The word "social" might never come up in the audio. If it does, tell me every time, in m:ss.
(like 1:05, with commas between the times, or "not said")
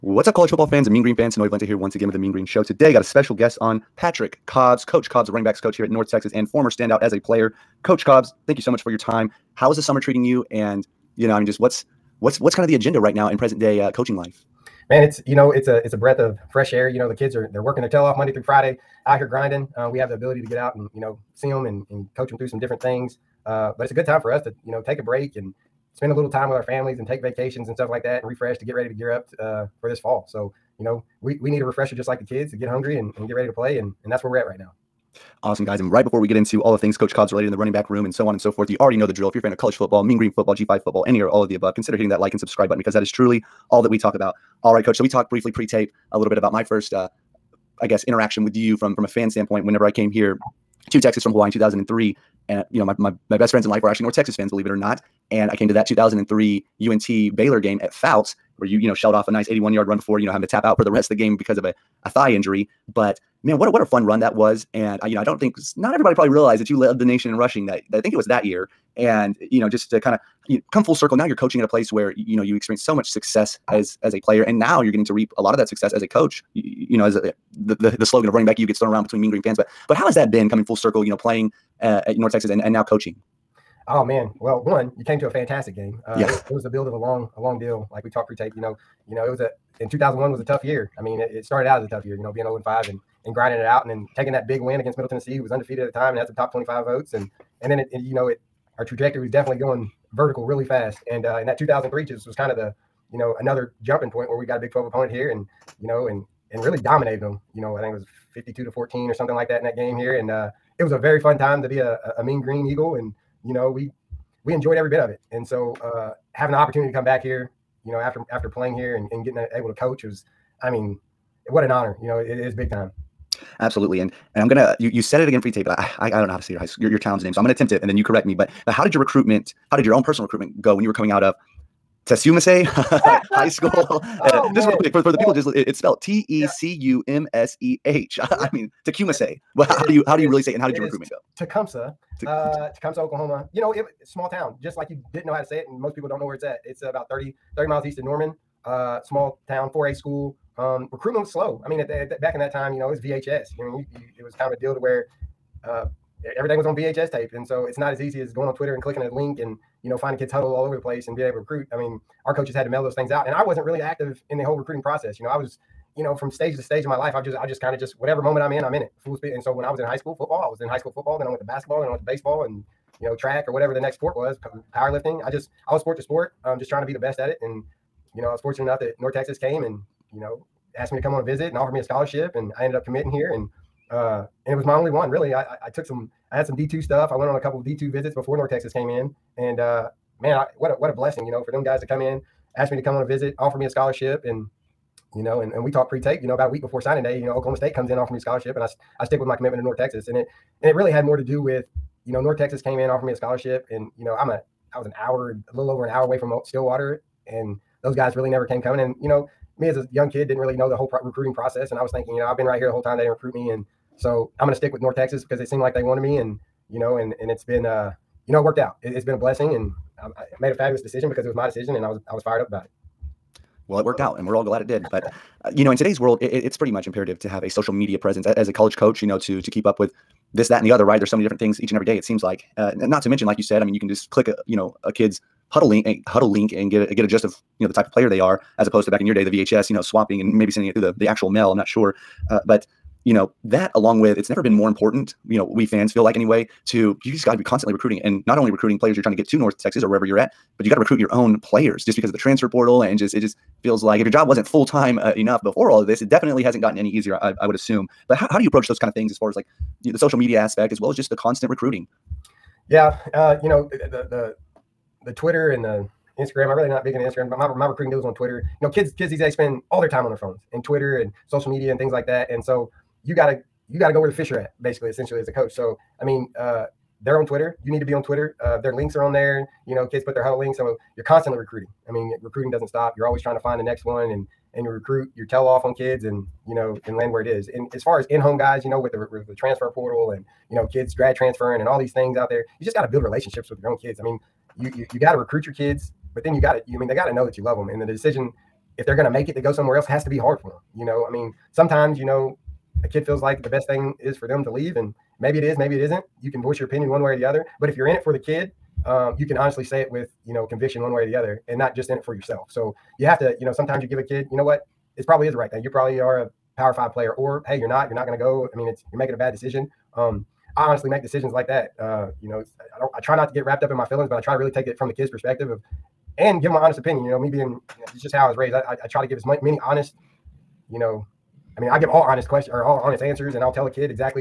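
3:47, 4:19, 4:31.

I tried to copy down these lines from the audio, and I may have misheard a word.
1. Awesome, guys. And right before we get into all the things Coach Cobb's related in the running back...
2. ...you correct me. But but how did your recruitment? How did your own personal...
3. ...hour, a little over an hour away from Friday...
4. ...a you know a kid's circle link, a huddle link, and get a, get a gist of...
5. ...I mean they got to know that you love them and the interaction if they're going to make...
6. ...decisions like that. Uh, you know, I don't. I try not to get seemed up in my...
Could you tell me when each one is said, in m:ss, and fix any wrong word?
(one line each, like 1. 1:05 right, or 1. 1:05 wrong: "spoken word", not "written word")
1. 0:35 right
2. 2:07 right
3. 3:24 wrong: "Stillwater", not "Friday"
4. 3:54 wrong: "huddle", not "circle"
5. 4:56 wrong: "decision", not "interaction"
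6. 5:21 wrong: "wrapped", not "seemed".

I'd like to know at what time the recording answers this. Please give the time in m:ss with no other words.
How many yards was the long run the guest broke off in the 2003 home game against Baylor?
0:59.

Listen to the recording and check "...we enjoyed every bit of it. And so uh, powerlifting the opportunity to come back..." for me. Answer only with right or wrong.
wrong.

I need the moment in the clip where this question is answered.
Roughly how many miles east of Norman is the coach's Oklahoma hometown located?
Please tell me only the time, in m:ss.
2:27.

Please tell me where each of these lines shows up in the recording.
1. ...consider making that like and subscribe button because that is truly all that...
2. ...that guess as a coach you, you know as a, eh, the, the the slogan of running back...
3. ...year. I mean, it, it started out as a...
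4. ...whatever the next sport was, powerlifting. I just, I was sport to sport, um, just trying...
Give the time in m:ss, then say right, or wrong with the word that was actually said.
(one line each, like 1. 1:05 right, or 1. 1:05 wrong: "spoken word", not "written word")
1. 0:41 wrong: "hitting", not "making"
2. 1:15 wrong: "success", not "guess"
3. 1:30 right
4. 2:53 right.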